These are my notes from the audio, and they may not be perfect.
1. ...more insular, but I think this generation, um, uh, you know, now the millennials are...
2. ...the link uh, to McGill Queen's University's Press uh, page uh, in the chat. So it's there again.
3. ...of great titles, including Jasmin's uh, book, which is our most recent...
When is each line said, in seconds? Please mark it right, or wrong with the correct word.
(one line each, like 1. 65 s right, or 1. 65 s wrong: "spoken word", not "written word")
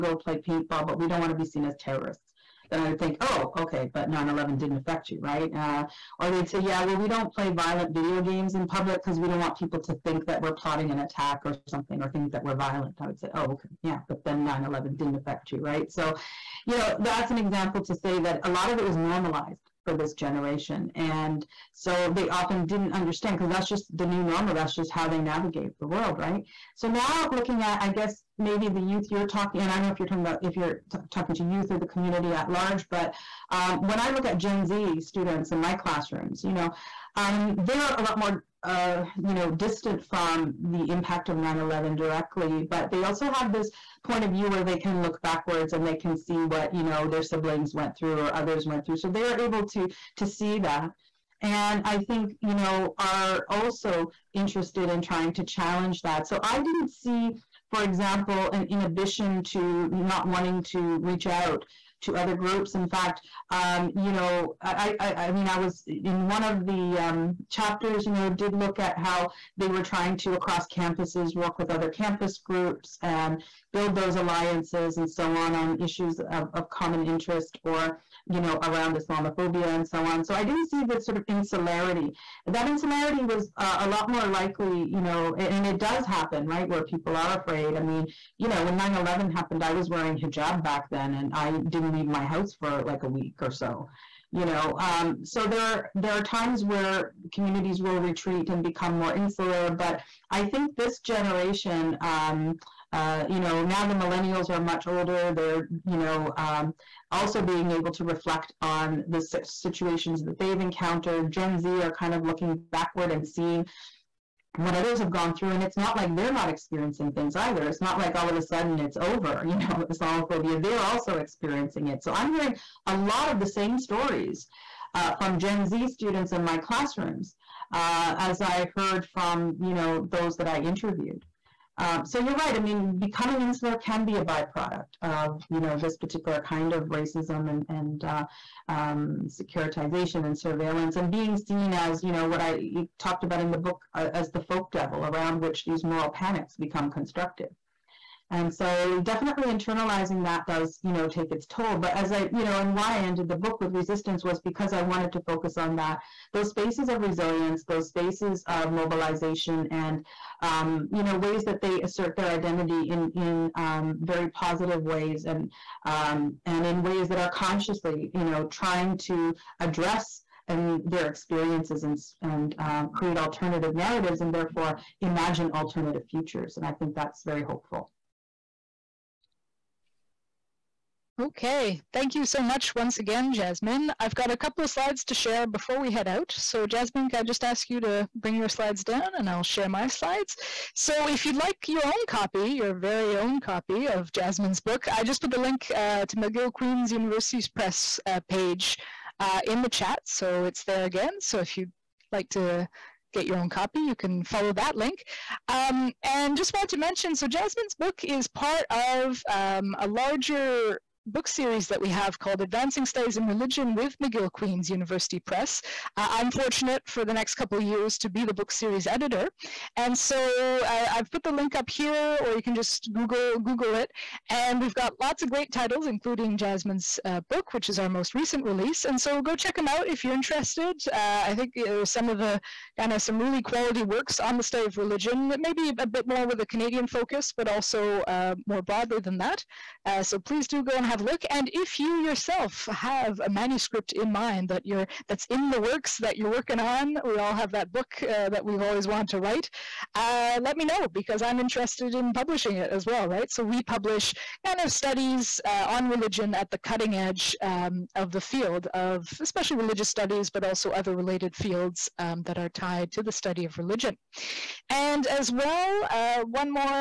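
1. 98 s right
2. 195 s right
3. 225 s right.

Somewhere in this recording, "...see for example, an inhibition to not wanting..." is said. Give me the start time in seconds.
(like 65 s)
56 s.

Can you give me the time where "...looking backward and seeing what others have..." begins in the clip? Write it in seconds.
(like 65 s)
112 s.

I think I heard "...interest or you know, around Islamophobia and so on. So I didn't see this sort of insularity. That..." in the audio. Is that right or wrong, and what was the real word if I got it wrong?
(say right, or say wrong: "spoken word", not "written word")
right.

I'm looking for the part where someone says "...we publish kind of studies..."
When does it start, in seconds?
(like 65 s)
253 s.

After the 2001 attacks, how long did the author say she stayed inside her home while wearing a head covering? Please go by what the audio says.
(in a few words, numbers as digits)
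a week.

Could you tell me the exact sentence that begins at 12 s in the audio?
I would say, oh, okay, yeah, but then 9-11 didn't affect you, right?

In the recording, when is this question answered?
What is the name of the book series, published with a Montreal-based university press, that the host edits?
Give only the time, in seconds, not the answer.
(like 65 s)
212 s.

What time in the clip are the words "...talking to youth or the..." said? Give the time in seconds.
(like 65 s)
31 s.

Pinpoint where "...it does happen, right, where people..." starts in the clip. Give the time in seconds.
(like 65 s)
85 s.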